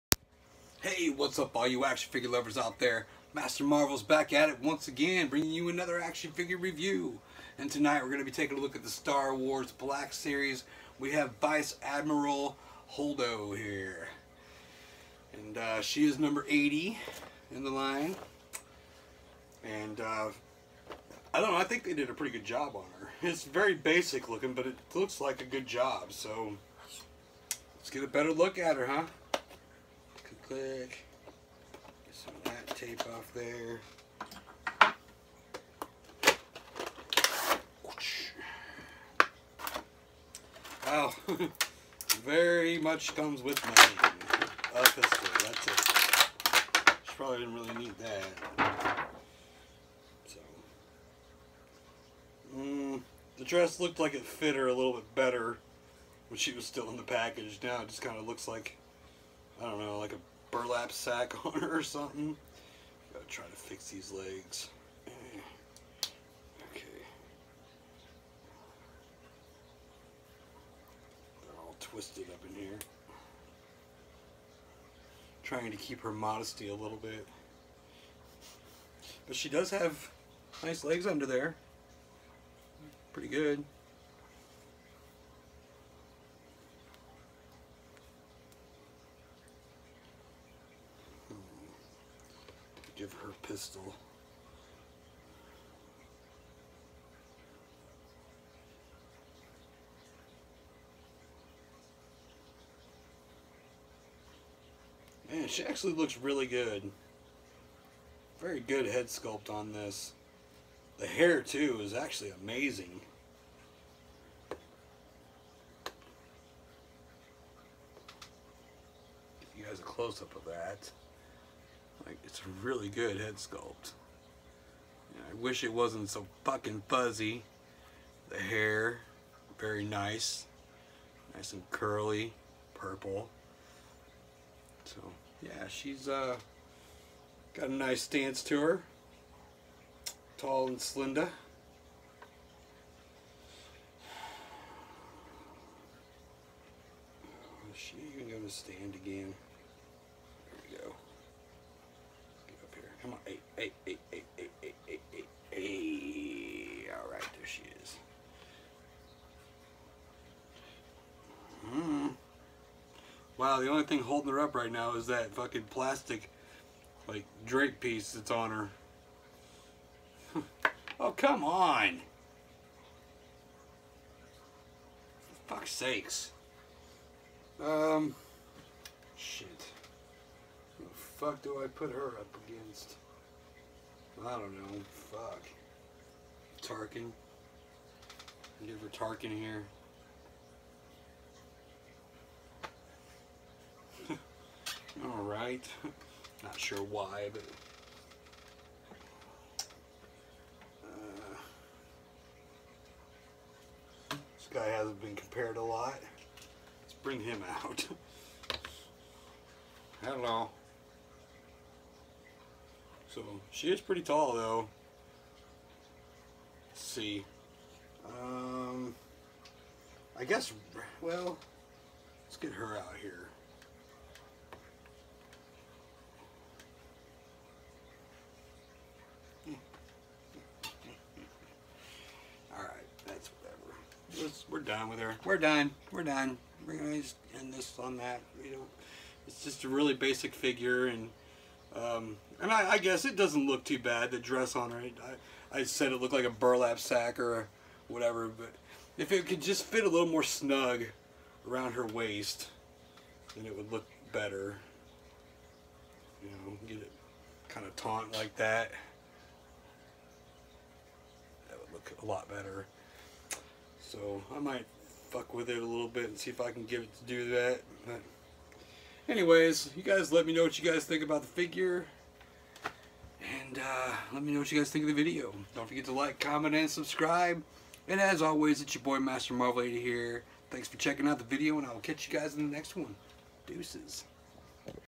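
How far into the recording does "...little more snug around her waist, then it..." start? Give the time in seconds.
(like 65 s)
249 s.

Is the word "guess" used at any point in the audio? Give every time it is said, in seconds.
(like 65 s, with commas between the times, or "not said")
220 s, 242 s.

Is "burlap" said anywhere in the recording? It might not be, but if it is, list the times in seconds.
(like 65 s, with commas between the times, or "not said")
60 s, 246 s.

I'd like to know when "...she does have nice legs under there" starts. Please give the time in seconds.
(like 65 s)
79 s.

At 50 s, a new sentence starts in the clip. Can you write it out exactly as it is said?
So, mm, the dress looked like it fit her a little bit better when she was still in the package.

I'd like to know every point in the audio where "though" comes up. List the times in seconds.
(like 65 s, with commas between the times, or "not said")
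214 s.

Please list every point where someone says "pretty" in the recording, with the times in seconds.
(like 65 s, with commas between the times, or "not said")
22 s, 83 s, 213 s.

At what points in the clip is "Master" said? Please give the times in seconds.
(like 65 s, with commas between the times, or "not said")
3 s, 278 s.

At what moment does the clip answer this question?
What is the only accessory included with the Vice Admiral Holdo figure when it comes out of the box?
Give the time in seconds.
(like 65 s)
44 s.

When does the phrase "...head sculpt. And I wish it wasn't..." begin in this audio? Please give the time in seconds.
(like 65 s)
123 s.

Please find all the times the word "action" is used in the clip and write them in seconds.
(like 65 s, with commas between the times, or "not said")
1 s, 6 s.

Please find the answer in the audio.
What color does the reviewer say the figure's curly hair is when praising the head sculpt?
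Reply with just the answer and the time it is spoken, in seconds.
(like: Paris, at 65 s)
Purple, at 132 s.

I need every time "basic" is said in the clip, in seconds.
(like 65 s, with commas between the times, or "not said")
23 s, 239 s.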